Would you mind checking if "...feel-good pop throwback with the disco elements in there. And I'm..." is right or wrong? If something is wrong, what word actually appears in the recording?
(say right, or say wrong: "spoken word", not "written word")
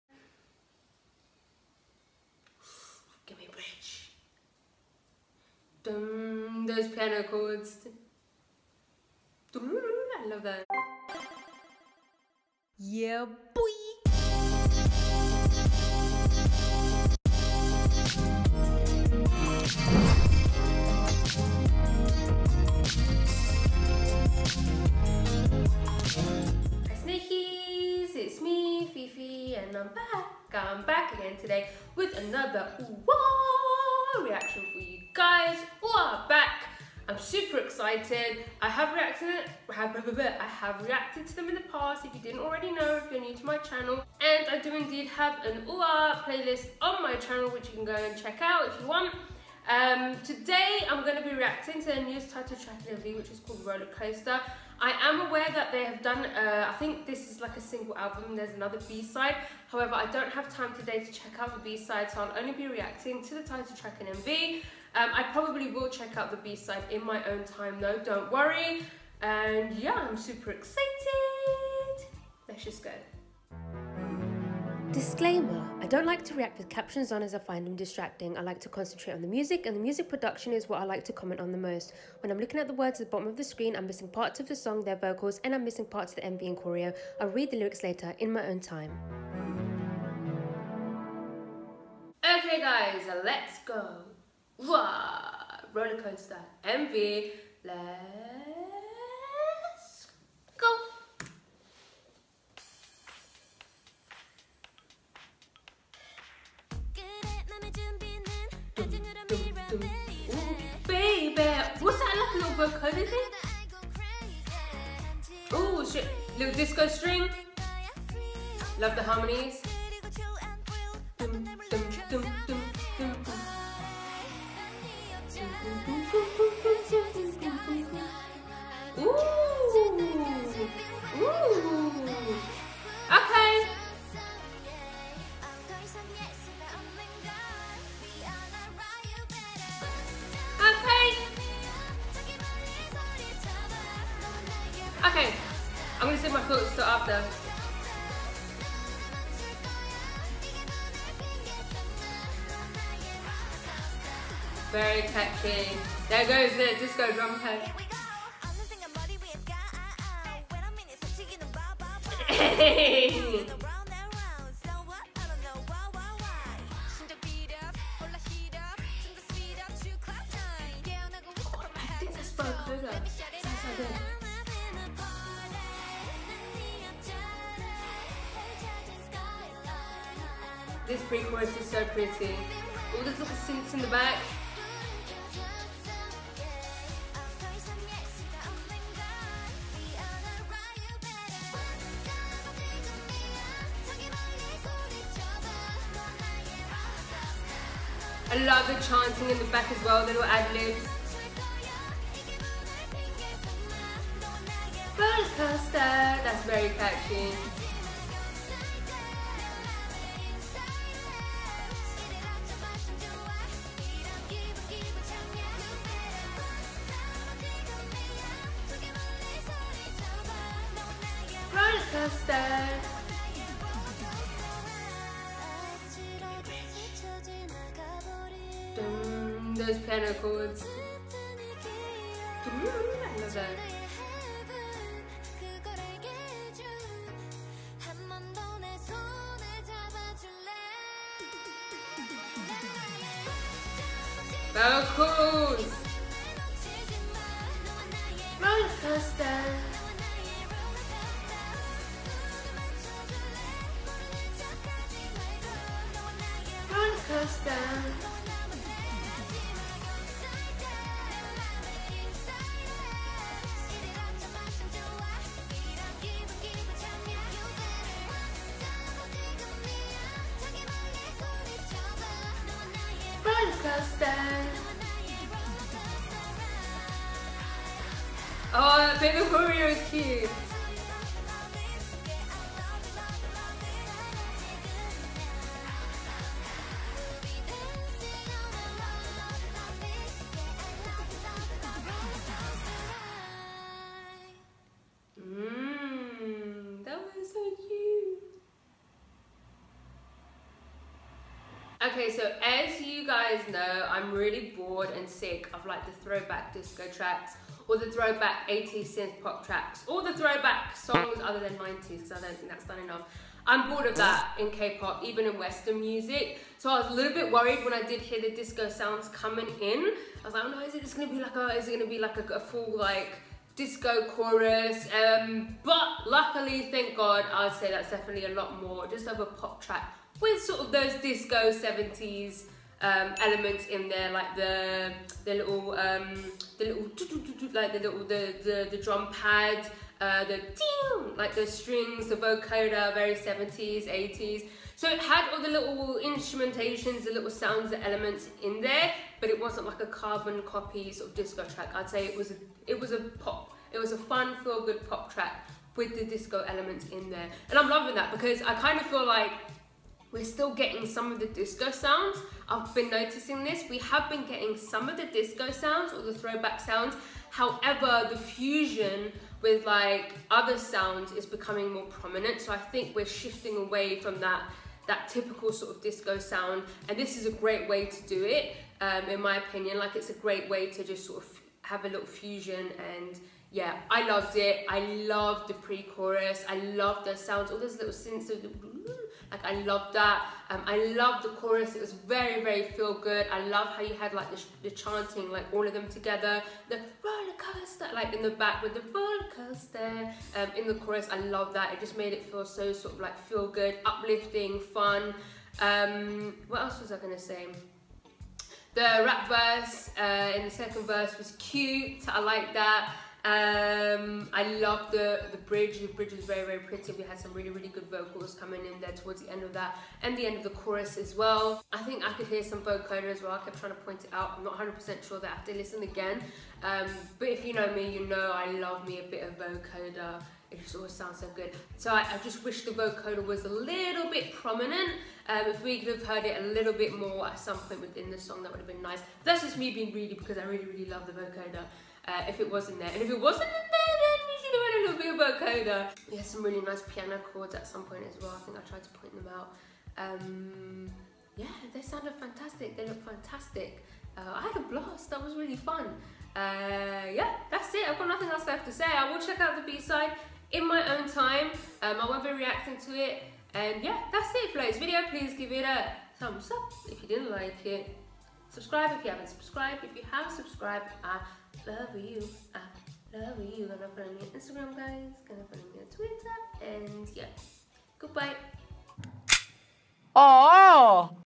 wrong: "track", not "throwback".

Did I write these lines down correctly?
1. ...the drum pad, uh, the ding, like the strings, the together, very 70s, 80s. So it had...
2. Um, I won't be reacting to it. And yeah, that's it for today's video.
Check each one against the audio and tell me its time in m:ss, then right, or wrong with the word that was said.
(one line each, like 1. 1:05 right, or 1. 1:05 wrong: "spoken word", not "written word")
1. 5:38 wrong: "vocoder", not "together"
2. 7:41 right.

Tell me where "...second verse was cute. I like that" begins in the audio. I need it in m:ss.
6:50.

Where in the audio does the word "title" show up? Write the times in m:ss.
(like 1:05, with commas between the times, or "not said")
0:52, 1:03.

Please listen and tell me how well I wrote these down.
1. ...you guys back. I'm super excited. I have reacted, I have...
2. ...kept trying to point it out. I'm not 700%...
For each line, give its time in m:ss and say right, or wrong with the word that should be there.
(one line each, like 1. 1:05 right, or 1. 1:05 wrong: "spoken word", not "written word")
1. 0:34 right
2. 7:03 wrong: "100", not "700".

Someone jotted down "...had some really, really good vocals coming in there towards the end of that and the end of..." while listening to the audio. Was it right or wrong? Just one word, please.
right.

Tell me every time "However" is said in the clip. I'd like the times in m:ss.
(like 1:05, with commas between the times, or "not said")
0:59, 6:07.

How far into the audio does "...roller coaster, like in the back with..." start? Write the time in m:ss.
6:36.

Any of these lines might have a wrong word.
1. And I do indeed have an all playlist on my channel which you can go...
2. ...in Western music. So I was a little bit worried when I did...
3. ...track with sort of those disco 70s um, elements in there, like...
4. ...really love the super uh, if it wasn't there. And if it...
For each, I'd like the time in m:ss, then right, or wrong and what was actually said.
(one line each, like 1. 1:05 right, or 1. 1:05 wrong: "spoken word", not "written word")
1. 0:44 right
2. 5:15 right
3. 5:29 right
4. 7:20 wrong: "vocoder", not "super".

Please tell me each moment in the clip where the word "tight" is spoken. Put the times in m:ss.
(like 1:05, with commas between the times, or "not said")
not said.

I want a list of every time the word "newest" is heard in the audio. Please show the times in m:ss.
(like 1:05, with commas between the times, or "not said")
0:52.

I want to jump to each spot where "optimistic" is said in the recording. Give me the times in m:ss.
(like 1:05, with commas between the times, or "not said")
not said.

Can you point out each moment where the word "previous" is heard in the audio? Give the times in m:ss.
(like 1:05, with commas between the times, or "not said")
not said.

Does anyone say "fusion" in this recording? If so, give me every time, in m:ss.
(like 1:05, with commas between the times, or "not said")
6:08, 6:22.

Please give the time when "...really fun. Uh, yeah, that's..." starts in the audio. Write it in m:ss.
7:35.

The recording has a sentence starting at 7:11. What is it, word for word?
So I, I just wish the vocoder was a little bit prominent.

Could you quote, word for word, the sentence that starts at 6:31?
It was very, very feel good.